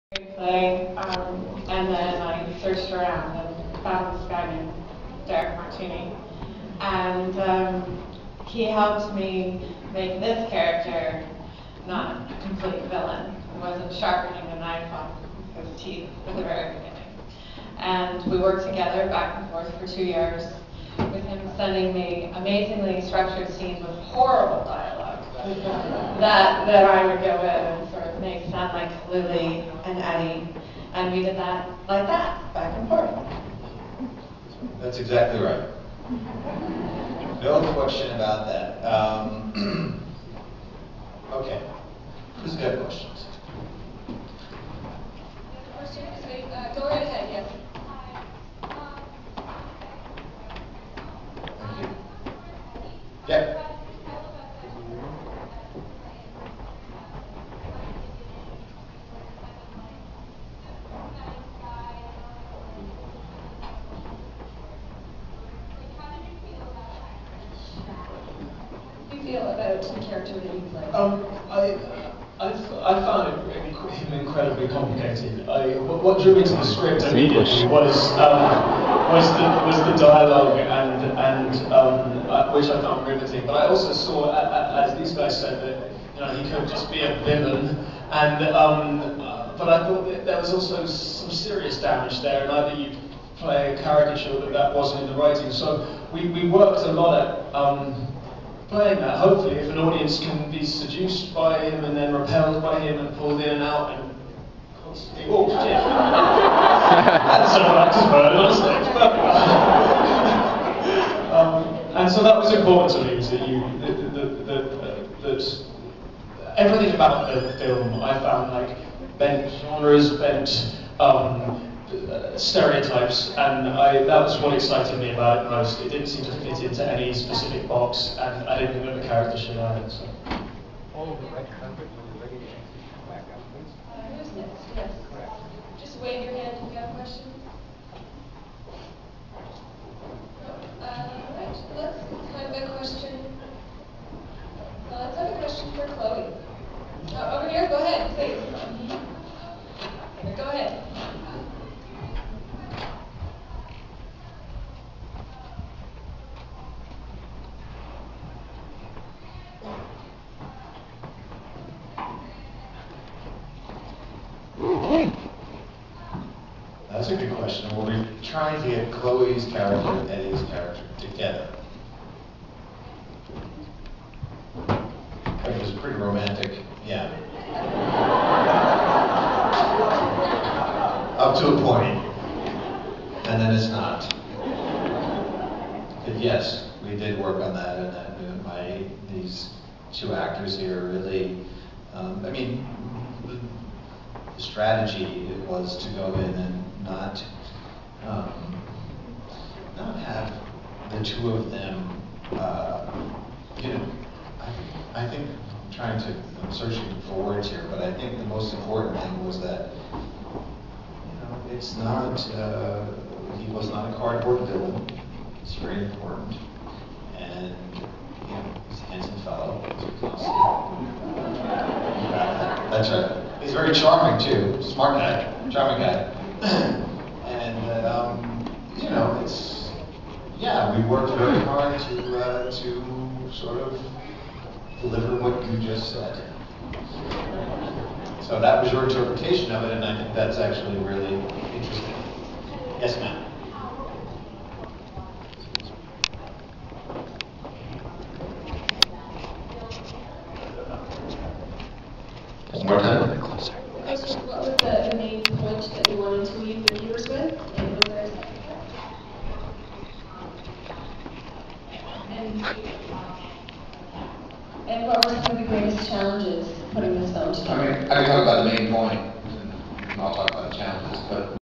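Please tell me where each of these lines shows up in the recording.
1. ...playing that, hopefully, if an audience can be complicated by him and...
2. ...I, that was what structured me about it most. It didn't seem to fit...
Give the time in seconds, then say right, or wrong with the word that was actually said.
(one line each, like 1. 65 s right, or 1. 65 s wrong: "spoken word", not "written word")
1. 98 s wrong: "seduced", not "complicated"
2. 123 s wrong: "excited", not "structured".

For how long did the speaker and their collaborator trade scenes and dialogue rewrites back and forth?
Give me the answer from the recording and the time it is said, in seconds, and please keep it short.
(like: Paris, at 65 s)
two years, at 19 s.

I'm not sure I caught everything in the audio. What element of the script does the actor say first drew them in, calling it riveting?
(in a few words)
the dialogue.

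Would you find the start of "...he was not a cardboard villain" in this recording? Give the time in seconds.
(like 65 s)
213 s.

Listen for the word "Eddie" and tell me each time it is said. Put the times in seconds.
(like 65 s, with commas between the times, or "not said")
29 s, 170 s.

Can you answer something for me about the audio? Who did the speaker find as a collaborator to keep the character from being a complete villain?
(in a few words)
Derick Martini.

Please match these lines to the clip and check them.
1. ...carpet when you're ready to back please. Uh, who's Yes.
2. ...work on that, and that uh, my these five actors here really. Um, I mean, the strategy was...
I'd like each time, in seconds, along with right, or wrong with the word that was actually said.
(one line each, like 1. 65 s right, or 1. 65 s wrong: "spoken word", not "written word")
1. 131 s right
2. 187 s wrong: "two", not "five".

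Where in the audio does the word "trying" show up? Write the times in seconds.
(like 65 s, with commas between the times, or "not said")
168 s, 205 s.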